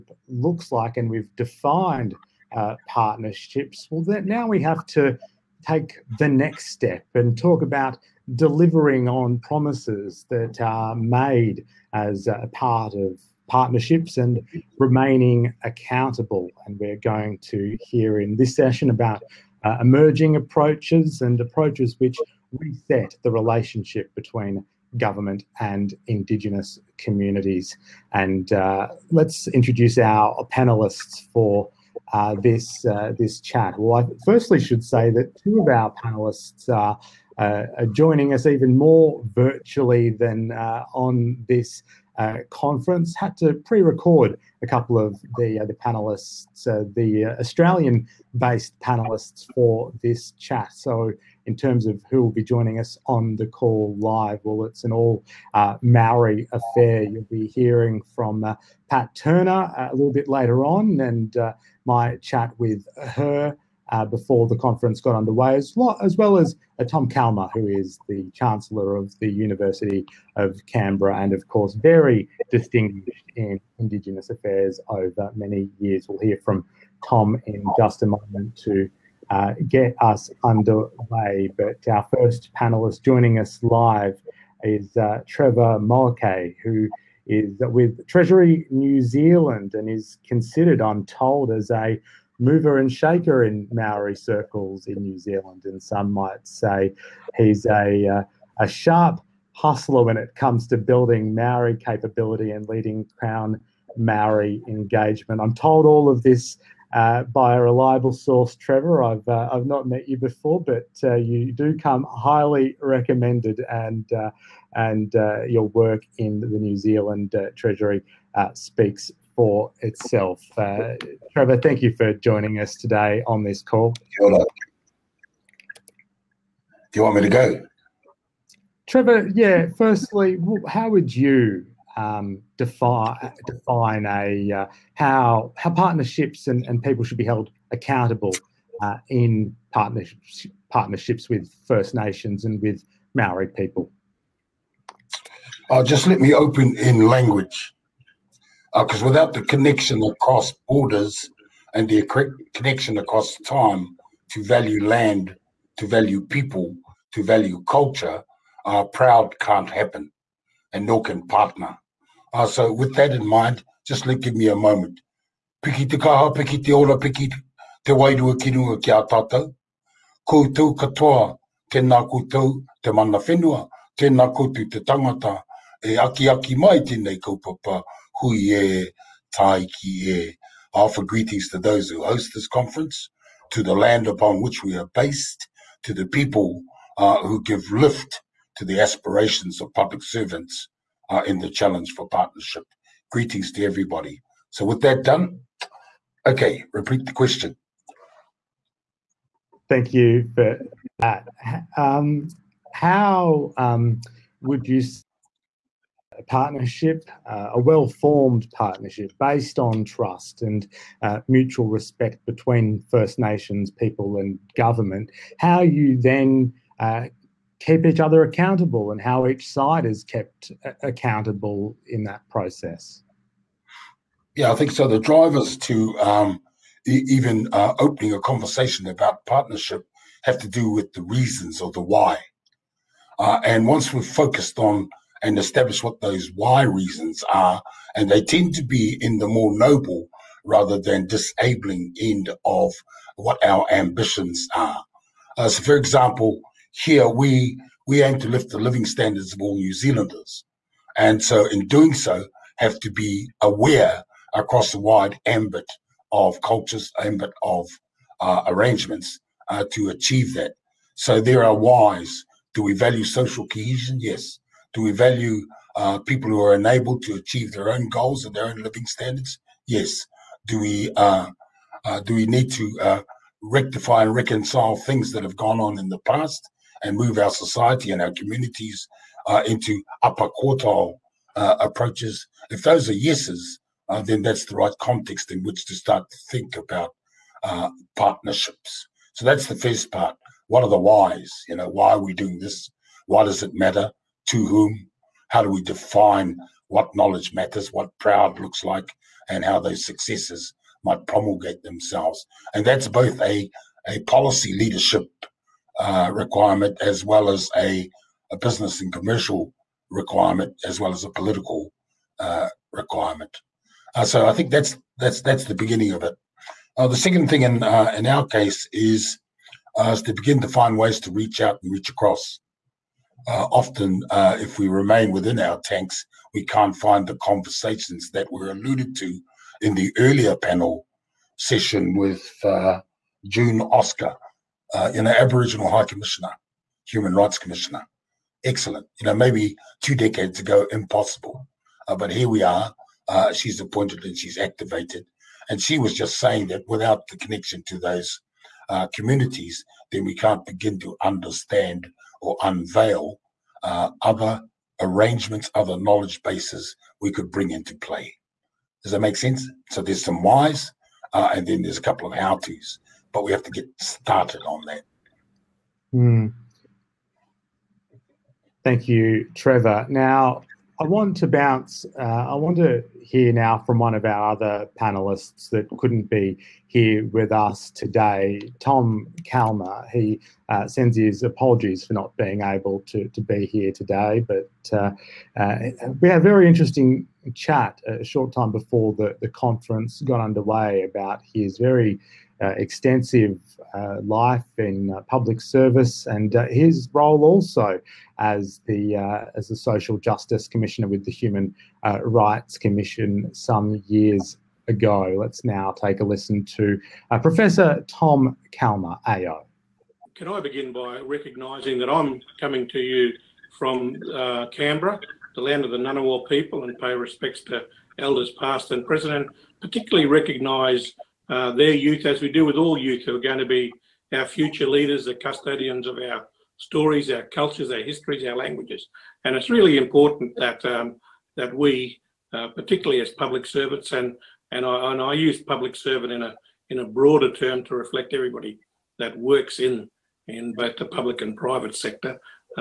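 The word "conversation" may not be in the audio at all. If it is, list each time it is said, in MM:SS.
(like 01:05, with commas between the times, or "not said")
03:48, 05:27.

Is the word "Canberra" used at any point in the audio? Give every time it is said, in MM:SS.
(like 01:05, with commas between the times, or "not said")
01:10, 06:54.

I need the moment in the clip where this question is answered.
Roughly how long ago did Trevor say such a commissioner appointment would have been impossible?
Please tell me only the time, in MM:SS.
05:39.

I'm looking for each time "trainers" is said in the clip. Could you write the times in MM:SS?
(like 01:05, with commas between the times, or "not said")
not said.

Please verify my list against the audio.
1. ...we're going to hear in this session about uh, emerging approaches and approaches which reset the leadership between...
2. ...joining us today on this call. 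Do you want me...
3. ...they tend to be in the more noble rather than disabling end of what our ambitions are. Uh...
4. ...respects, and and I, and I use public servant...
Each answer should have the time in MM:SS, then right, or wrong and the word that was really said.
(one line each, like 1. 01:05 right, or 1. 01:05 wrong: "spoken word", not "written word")
1. 00:16 wrong: "relationship", not "leadership"
2. 02:02 right
3. 03:58 right
4. 07:13 wrong: "servants", not "respects".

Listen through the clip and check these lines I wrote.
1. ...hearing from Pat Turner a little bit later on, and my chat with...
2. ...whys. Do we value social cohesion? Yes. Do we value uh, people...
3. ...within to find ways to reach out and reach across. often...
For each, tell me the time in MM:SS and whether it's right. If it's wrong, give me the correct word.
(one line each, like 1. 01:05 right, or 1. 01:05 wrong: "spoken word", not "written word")
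1. 00:57 right
2. 04:21 right
3. 05:20 wrong: "begin", not "within".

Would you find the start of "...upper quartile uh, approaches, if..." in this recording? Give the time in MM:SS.
04:40.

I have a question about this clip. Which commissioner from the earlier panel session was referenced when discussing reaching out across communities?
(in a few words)
June Oscar.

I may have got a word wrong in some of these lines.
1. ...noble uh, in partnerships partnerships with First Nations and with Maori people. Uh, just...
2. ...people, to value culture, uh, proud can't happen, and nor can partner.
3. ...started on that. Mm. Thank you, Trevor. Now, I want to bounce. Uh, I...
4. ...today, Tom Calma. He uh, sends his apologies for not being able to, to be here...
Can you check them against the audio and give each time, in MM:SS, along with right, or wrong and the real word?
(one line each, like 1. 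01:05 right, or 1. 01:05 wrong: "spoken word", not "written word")
1. 02:17 wrong: "accountable", not "noble"
2. 02:36 right
3. 06:03 right
4. 06:17 right.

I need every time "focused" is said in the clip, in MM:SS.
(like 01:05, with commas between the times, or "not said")
03:54.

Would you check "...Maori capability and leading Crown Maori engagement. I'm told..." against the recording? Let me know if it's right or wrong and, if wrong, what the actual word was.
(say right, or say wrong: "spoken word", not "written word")
right.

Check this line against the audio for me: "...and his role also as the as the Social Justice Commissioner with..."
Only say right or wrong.
right.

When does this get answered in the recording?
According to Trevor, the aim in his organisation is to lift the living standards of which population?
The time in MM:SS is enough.
04:09.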